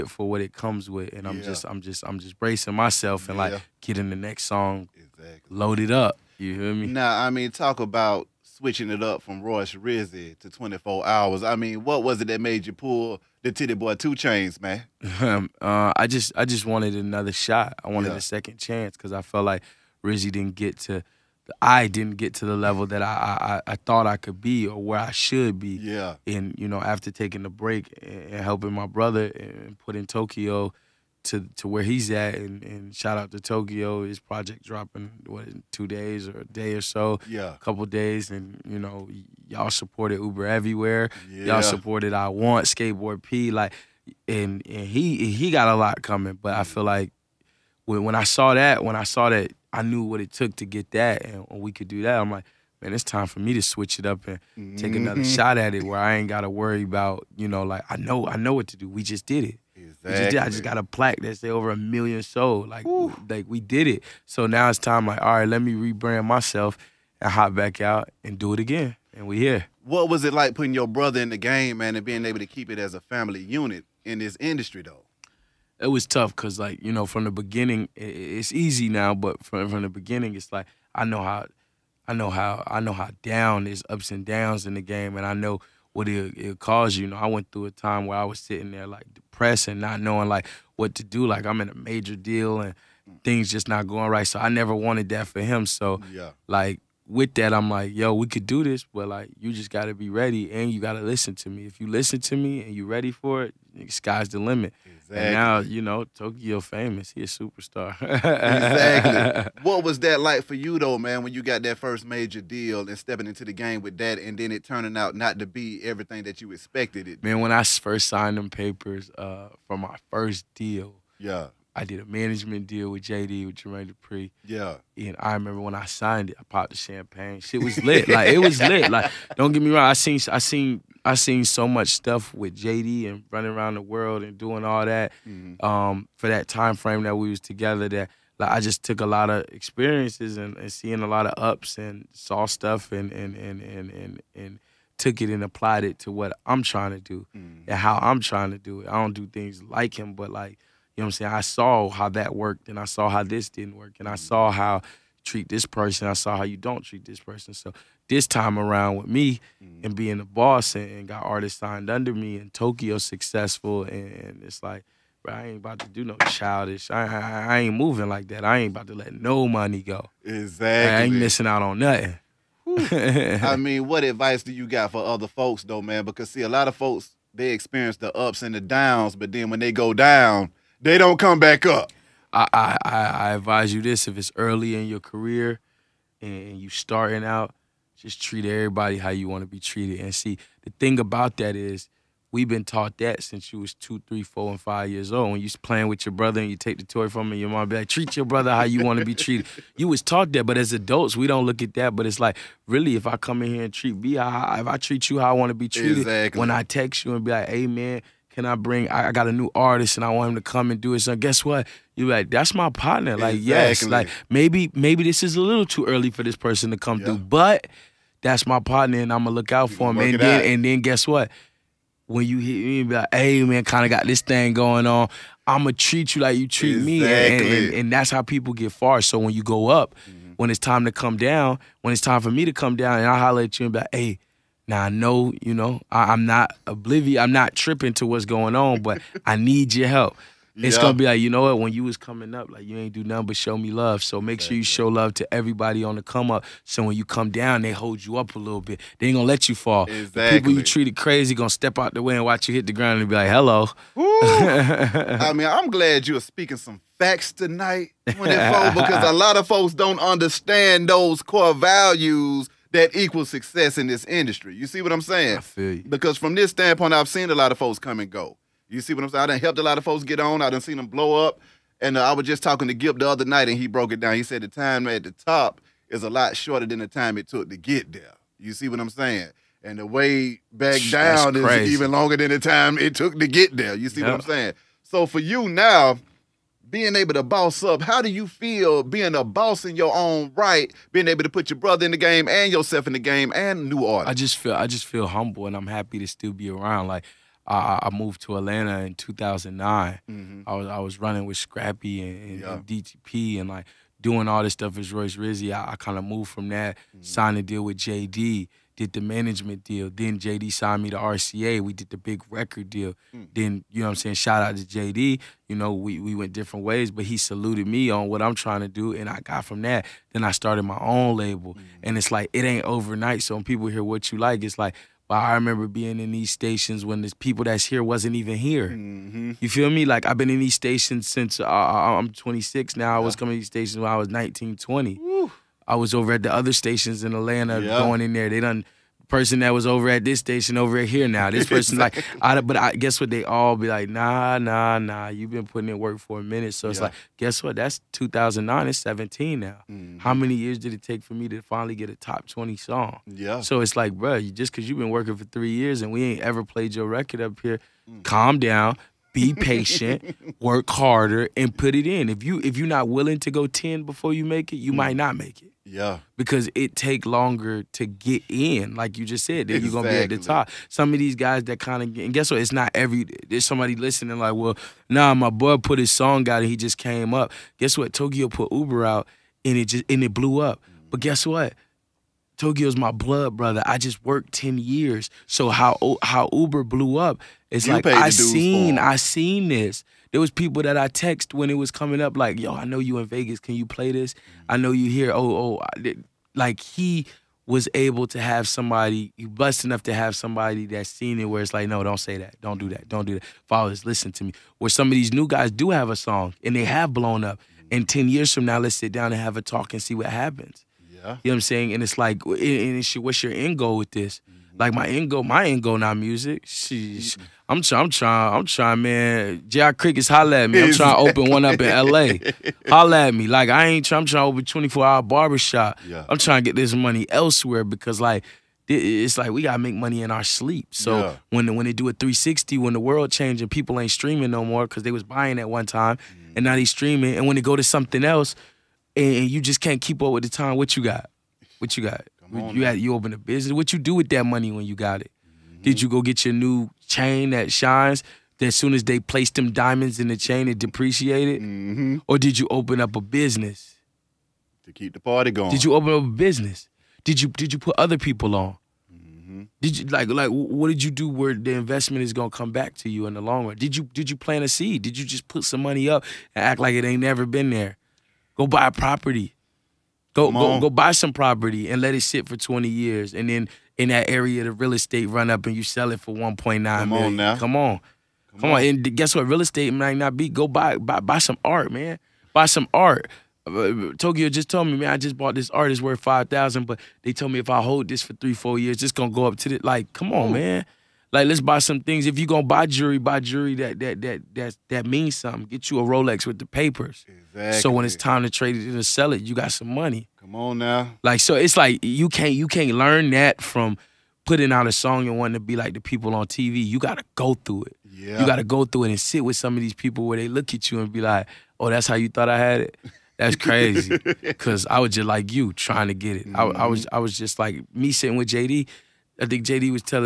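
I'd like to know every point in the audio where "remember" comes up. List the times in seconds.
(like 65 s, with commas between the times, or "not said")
125 s, 325 s.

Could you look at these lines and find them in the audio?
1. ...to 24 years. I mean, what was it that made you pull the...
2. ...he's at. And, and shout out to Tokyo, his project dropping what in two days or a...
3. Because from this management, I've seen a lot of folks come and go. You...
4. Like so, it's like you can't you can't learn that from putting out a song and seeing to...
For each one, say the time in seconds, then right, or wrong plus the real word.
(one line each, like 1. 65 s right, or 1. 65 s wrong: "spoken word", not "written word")
1. 10 s wrong: "hours", not "years"
2. 31 s right
3. 265 s wrong: "standpoint", not "management"
4. 501 s wrong: "wanting", not "seeing".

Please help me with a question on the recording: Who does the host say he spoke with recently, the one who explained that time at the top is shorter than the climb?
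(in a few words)
Gipp.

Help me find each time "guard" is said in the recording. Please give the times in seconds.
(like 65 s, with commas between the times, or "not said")
not said.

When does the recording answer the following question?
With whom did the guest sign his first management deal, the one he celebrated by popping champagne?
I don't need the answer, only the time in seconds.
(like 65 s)
123 s.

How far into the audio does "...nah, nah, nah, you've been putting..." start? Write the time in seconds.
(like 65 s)
343 s.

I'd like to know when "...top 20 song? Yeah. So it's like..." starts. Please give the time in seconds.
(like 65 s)
351 s.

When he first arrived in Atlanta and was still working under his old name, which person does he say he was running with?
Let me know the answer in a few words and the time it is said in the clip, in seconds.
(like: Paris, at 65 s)
Scrappy, at 301 s.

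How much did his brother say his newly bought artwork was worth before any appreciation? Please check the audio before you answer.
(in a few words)
5000.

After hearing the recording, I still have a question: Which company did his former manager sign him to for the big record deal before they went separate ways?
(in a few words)
RCA.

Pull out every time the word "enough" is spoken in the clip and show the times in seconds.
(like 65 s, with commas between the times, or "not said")
399 s.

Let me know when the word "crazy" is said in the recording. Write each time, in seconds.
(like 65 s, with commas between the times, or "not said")
250 s, 513 s.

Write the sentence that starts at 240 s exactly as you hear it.
gonna be like, you know what, when you was coming up, like you ain't do nothing but show me love.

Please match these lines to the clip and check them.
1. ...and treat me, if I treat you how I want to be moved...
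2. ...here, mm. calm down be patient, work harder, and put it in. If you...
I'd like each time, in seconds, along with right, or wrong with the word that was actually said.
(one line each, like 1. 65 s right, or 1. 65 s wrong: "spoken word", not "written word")
1. 203 s wrong: "treated", not "moved"
2. 357 s right.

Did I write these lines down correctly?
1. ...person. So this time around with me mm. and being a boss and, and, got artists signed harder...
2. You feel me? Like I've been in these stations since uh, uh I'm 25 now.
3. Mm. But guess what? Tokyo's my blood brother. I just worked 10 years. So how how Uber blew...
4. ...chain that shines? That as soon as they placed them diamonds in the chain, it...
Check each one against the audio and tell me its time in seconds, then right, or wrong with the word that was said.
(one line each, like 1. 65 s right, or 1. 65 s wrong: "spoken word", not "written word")
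1. 157 s wrong: "under", not "harder"
2. 329 s wrong: "26", not "25"
3. 380 s right
4. 446 s right.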